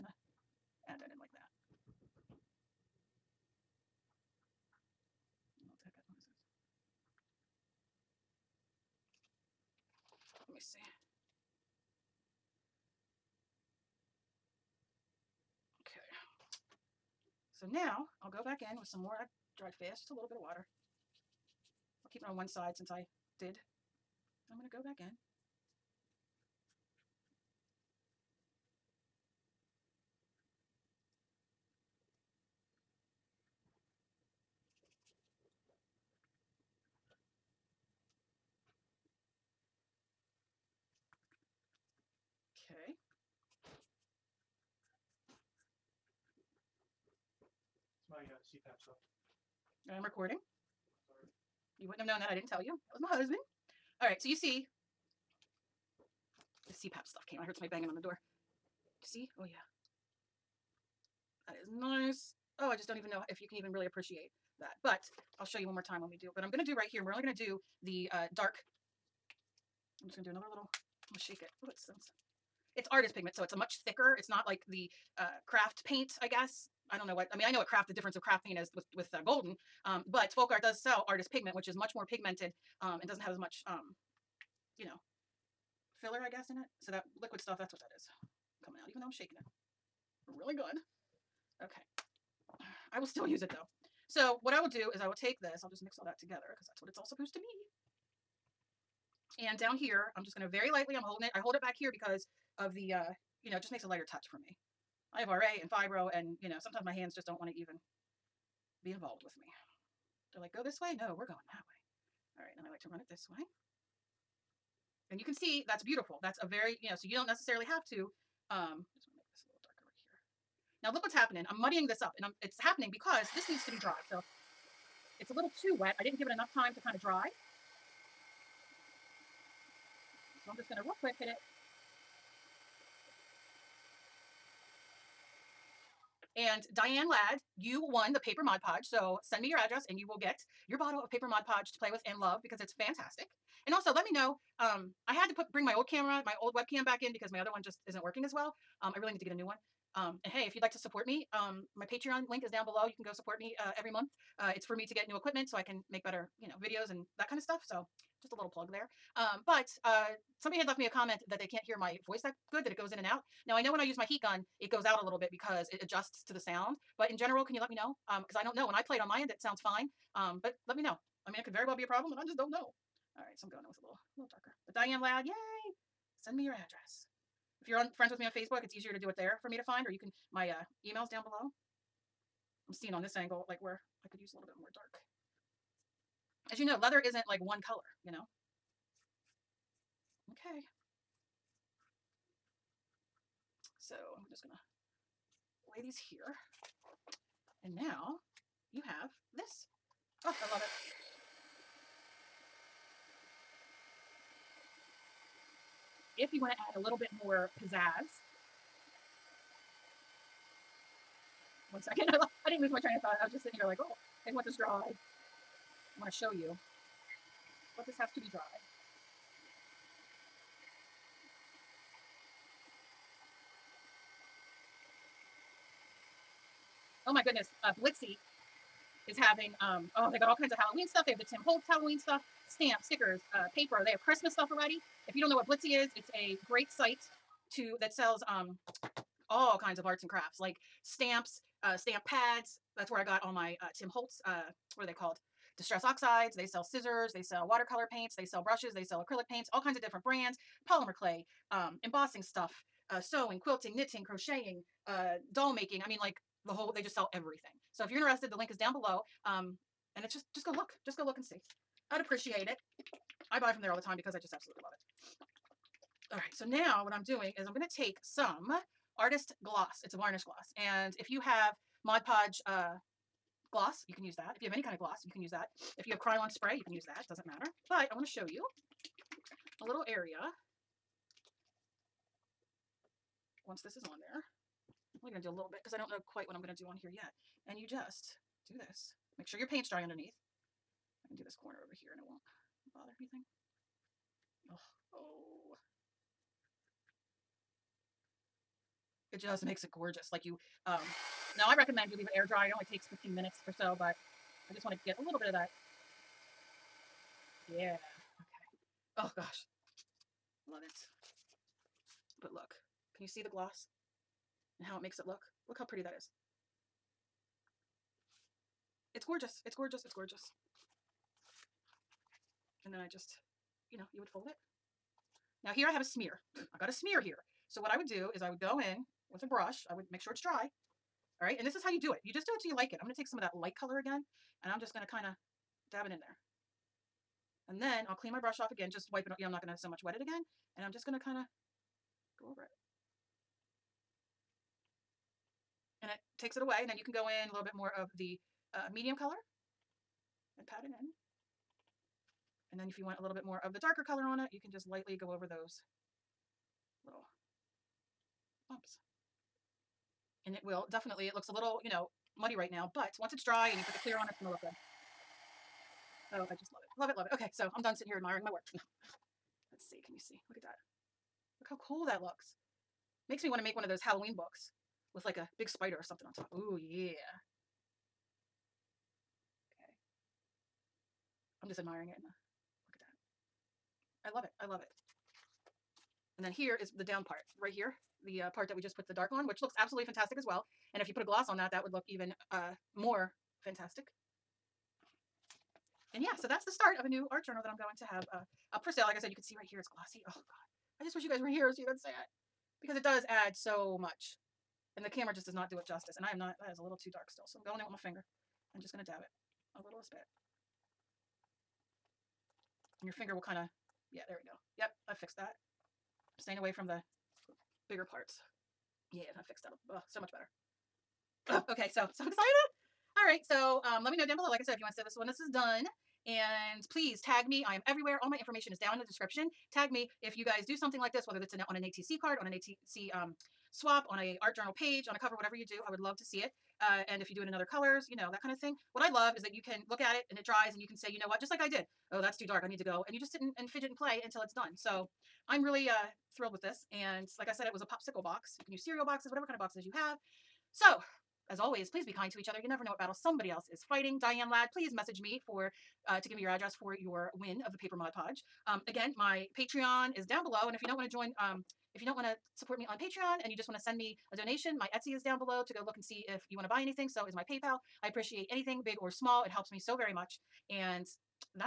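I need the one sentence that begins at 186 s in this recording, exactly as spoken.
As you know, leather isn't like one color, you know?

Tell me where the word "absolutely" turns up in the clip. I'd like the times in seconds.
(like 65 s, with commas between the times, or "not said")
264 s, 389 s.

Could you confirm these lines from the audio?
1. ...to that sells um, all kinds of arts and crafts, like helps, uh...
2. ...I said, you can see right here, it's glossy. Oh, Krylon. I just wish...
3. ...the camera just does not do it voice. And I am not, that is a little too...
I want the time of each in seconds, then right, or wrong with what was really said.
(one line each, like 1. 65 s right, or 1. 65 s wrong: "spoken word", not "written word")
1. 237 s wrong: "stamps", not "helps"
2. 398 s wrong: "God", not "Krylon"
3. 404 s wrong: "justice", not "voice".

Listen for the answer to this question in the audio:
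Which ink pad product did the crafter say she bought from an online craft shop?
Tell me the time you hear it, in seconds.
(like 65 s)
245 s.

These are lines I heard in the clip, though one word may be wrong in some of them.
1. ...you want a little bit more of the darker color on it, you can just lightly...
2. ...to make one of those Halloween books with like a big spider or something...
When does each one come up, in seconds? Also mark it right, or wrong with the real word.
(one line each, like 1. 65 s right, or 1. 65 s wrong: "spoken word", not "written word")
1. 352 s right
2. 373 s right.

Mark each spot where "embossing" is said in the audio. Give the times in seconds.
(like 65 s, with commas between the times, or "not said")
251 s.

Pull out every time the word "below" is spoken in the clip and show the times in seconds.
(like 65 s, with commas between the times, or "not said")
152 s, 181 s, 258 s, 424 s, 460 s, 465 s.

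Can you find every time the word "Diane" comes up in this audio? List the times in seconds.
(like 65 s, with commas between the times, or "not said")
136 s, 174 s, 454 s.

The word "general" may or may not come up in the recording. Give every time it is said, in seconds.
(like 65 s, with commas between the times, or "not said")
167 s.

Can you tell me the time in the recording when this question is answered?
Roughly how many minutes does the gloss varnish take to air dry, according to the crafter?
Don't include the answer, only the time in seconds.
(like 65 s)
302 s.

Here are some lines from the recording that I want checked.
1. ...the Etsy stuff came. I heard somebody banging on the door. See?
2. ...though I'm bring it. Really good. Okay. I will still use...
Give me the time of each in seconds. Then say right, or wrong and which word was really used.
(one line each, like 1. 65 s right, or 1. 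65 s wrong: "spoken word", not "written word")
1. 56 s wrong: "CPAP", not "Etsy"
2. 88 s wrong: "shaking", not "bring".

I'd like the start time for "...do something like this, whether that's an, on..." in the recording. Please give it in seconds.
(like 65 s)
430 s.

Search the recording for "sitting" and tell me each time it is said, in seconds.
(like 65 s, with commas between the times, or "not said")
213 s, 367 s.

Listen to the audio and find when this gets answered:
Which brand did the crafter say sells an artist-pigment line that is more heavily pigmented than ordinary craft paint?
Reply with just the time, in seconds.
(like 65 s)
80 s.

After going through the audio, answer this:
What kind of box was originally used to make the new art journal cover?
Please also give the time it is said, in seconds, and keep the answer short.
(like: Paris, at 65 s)
popsicle box, at 447 s.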